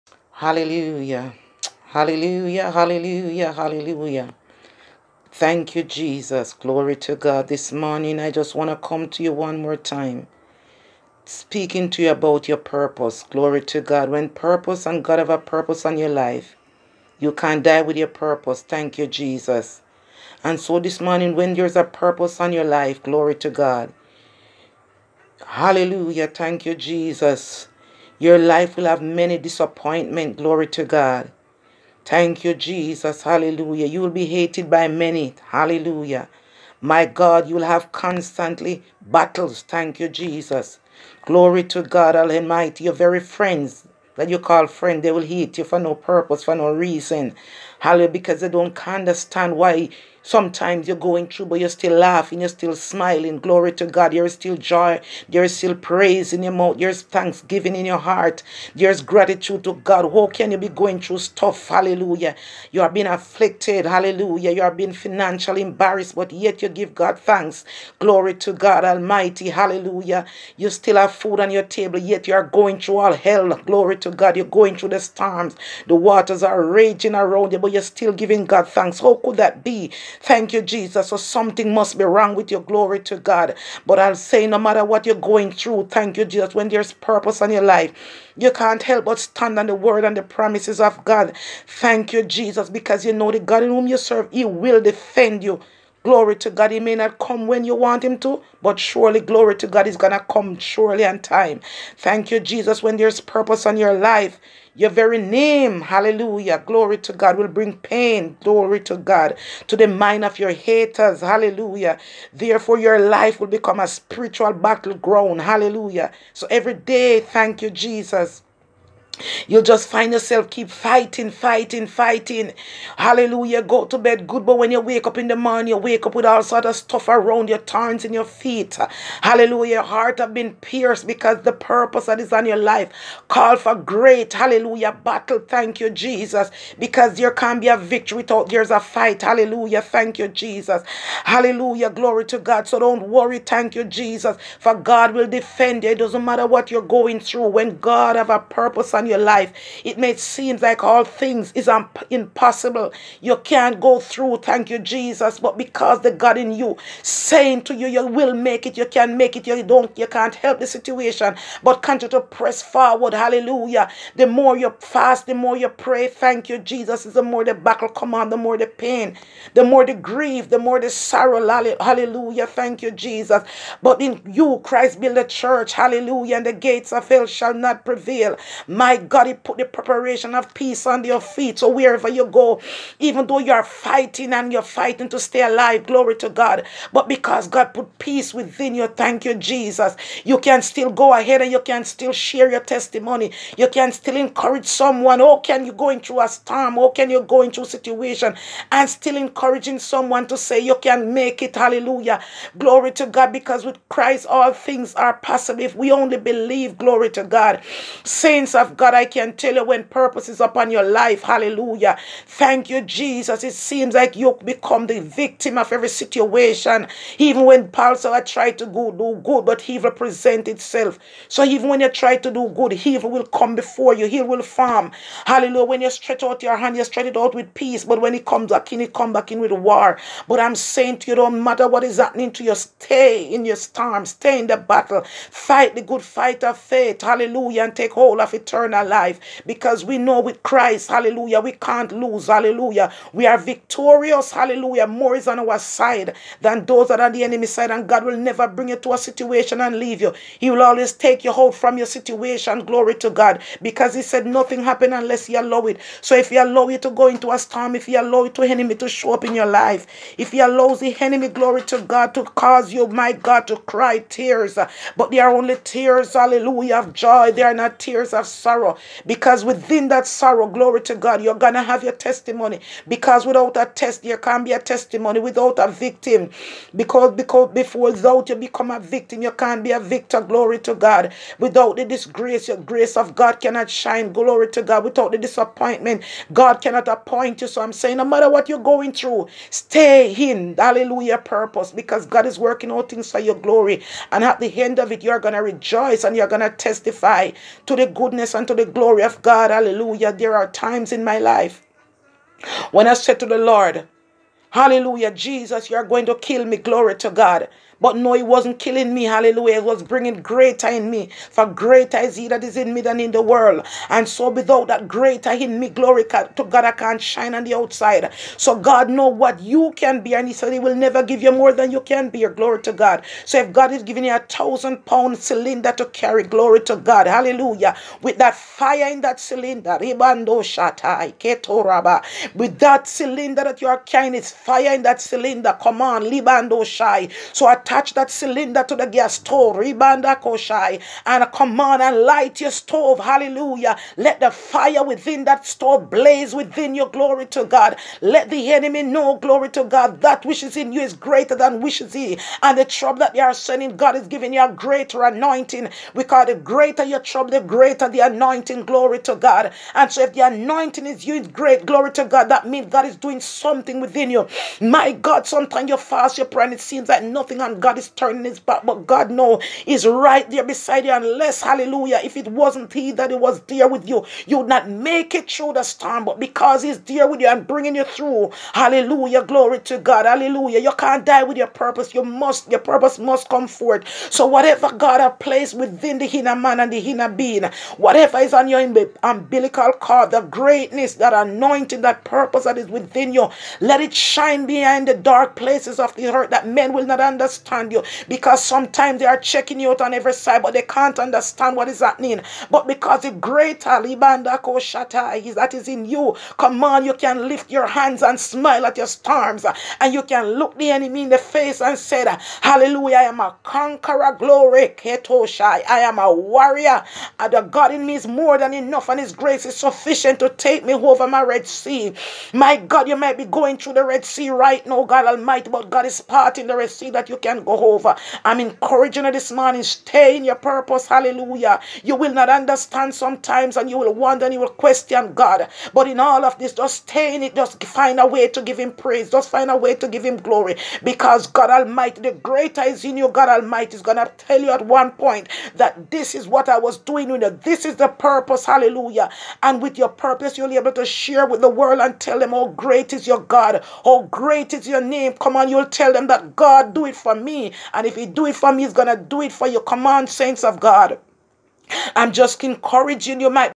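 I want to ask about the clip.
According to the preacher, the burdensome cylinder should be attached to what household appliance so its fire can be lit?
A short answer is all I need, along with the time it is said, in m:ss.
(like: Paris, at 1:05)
gas stove, at 5:38.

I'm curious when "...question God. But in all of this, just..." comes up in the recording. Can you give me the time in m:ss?
7:14.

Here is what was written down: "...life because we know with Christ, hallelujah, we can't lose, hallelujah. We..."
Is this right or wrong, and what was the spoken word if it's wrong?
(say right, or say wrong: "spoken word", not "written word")
right.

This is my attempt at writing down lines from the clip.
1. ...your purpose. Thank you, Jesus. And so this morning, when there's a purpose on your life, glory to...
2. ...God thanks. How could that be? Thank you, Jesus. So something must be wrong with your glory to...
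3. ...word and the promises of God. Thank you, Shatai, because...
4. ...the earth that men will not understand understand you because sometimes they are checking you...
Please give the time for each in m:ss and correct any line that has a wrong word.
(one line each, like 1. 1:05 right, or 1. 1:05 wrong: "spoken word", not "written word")
1. 0:17 right
2. 1:18 right
3. 1:29 wrong: "Jesus", not "Shatai"
4. 6:35 right.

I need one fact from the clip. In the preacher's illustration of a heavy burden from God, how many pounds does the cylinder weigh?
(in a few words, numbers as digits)
1000.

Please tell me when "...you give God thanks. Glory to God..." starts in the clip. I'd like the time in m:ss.
1:06.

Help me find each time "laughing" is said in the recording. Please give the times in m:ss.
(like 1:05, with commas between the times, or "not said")
0:51.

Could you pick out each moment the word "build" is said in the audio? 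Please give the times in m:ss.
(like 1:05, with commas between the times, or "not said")
2:54.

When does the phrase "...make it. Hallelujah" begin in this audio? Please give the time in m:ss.
3:21.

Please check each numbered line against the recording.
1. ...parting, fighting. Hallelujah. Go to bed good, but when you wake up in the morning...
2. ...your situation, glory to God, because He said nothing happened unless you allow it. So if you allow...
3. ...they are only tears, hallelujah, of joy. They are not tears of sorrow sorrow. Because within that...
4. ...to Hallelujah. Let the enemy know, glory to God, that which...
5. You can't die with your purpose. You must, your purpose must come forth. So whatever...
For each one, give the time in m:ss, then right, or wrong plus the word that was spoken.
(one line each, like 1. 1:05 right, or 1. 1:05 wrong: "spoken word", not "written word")
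1. 2:01 wrong: "fighting", not "parting"
2. 4:11 right
3. 4:25 right
4. 5:47 wrong: "God", not "Hallelujah"
5. 6:20 right.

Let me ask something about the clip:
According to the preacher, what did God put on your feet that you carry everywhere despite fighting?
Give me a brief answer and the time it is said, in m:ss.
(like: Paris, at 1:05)
preparation of peace, at 2:59.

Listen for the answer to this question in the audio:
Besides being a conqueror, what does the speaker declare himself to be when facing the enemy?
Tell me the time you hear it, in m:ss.
6:56.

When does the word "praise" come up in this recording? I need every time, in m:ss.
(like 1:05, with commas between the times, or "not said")
0:55, 7:18.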